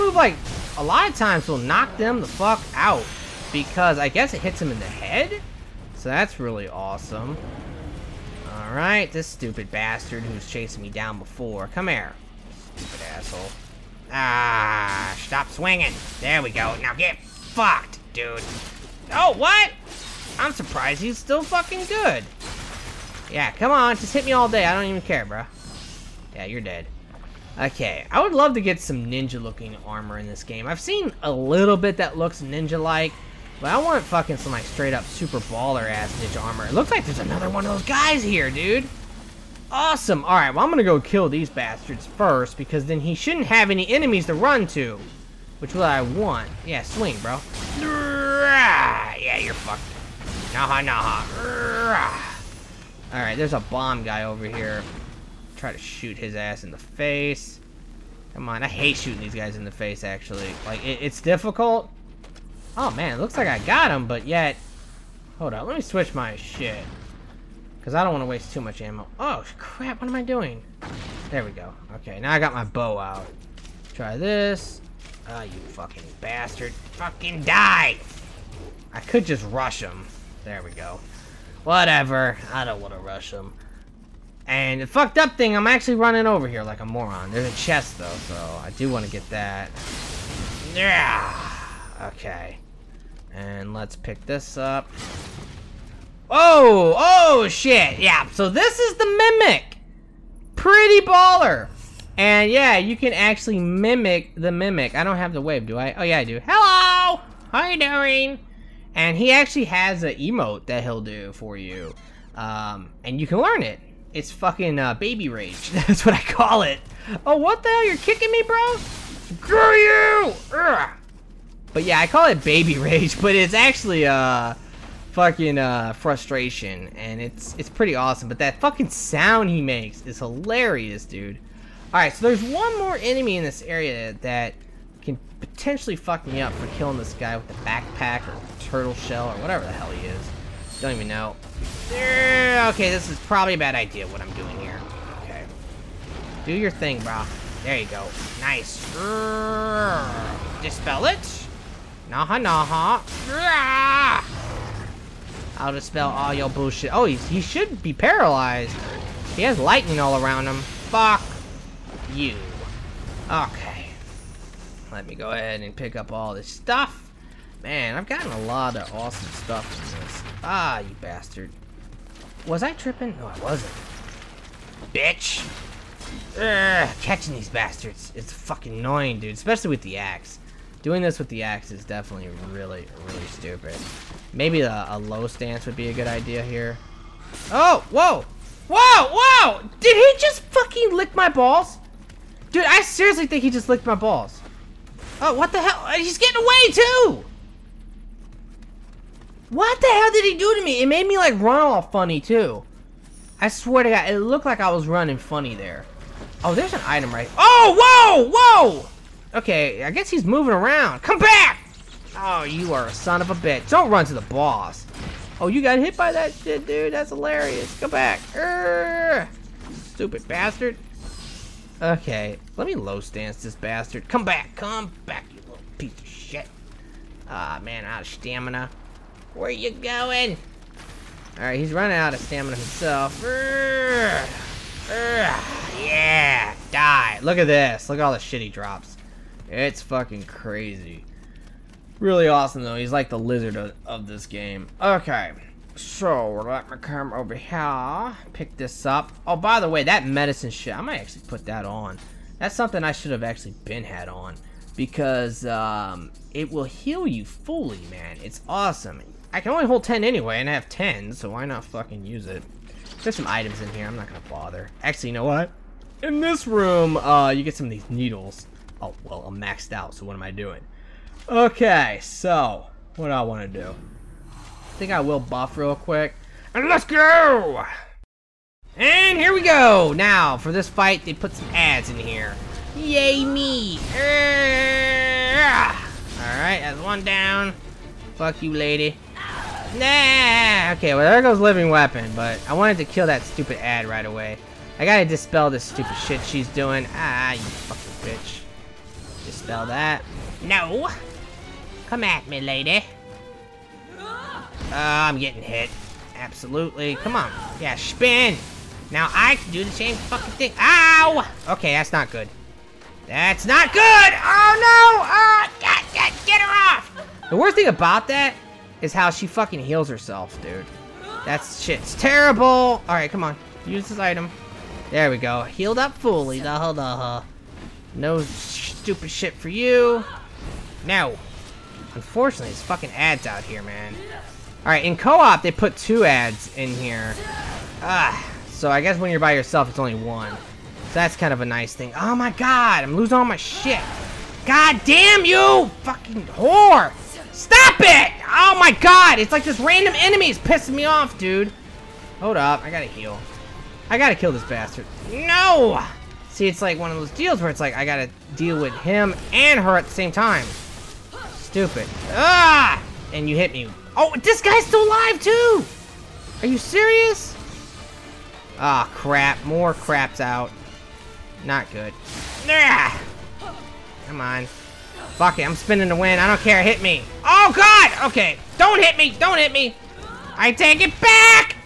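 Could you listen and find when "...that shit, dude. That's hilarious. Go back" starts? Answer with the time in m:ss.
3:36.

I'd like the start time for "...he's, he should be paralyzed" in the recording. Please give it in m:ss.
2:37.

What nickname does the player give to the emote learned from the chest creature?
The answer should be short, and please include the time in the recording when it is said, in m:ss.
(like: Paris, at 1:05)
Baby rage, at 1:54.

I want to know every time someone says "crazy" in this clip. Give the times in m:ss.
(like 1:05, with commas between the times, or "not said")
4:00.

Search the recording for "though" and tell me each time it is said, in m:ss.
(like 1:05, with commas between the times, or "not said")
1:27, 4:02.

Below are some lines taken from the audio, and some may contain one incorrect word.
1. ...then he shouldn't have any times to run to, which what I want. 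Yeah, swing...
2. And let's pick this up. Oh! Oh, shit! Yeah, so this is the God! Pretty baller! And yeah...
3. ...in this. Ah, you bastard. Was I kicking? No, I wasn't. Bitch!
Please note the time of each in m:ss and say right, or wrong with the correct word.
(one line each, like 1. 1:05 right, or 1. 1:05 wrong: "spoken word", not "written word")
1. 0:42 wrong: "enemies", not "times"
2. 1:33 wrong: "Mimic", not "God"
3. 2:49 wrong: "tripping", not "kicking".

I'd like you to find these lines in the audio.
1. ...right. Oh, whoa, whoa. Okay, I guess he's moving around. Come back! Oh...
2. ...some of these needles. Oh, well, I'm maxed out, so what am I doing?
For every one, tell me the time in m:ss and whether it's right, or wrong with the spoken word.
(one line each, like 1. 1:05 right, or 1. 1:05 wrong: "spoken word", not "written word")
1. 3:27 right
2. 4:27 right.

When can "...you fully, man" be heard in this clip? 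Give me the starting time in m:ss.
4:17.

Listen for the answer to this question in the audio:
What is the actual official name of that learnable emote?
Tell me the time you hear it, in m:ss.
2:05.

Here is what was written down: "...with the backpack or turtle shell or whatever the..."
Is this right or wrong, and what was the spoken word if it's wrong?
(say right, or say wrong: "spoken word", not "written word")
right.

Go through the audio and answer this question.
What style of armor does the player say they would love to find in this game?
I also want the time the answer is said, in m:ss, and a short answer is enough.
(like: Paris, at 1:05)
Ninja armor, at 0:29.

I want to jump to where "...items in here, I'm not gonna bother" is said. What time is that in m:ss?
4:23.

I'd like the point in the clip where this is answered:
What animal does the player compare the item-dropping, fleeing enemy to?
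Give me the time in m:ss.
4:03.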